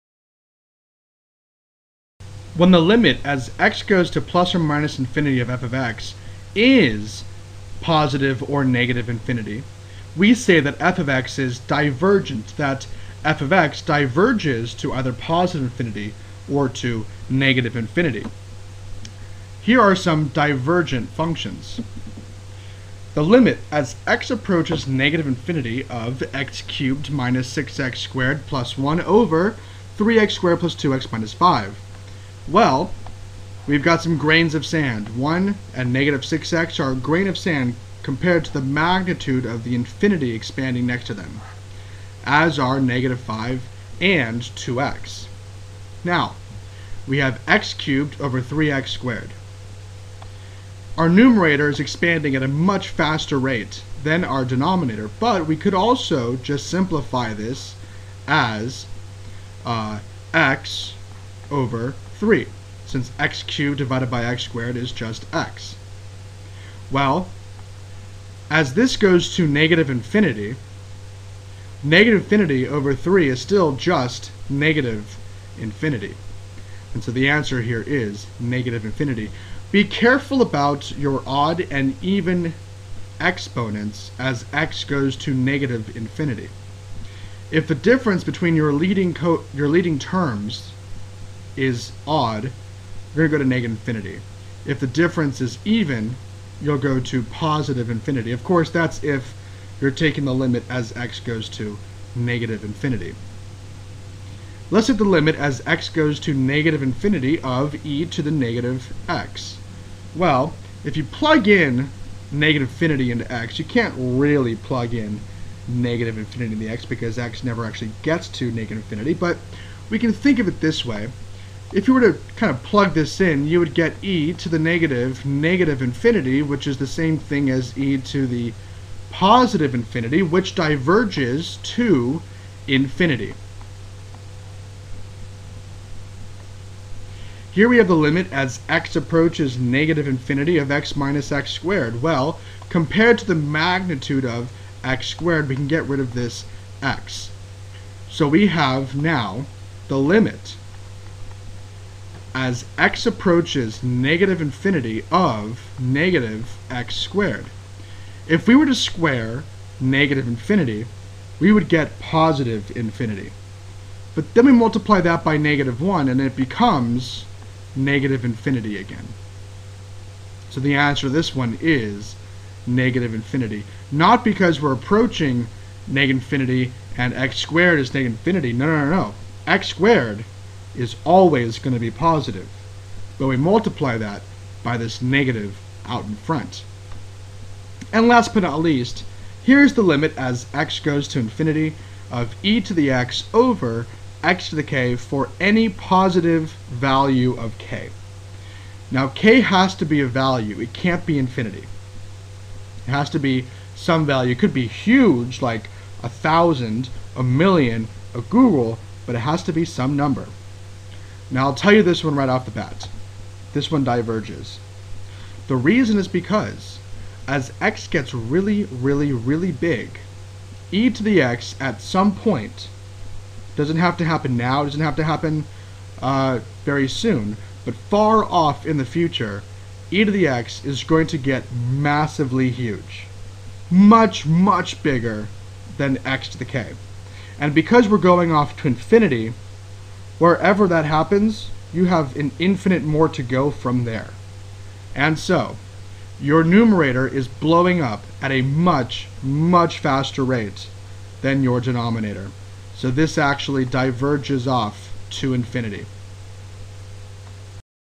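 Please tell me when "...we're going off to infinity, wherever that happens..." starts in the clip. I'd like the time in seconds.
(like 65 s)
237 s.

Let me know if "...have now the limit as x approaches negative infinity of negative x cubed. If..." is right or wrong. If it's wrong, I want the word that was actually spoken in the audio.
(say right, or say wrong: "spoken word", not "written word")
wrong: "squared", not "cubed".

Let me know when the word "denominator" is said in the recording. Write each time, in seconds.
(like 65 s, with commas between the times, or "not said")
54 s, 251 s.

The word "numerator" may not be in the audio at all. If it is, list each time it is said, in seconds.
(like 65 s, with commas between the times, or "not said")
51 s, 246 s.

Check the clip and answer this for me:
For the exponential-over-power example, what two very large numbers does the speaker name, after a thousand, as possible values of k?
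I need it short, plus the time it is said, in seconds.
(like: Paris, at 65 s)
a million, a googol, at 207 s.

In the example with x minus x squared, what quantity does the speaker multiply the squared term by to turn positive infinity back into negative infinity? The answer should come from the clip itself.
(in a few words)
negative 1.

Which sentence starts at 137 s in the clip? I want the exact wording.
Here we have the limit as x approaches negative infinity of x minus x squared.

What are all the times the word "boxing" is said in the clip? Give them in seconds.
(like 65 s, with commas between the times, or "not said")
not said.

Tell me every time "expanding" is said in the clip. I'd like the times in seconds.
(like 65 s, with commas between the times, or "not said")
40 s, 51 s.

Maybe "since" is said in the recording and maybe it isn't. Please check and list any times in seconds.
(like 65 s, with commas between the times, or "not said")
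62 s.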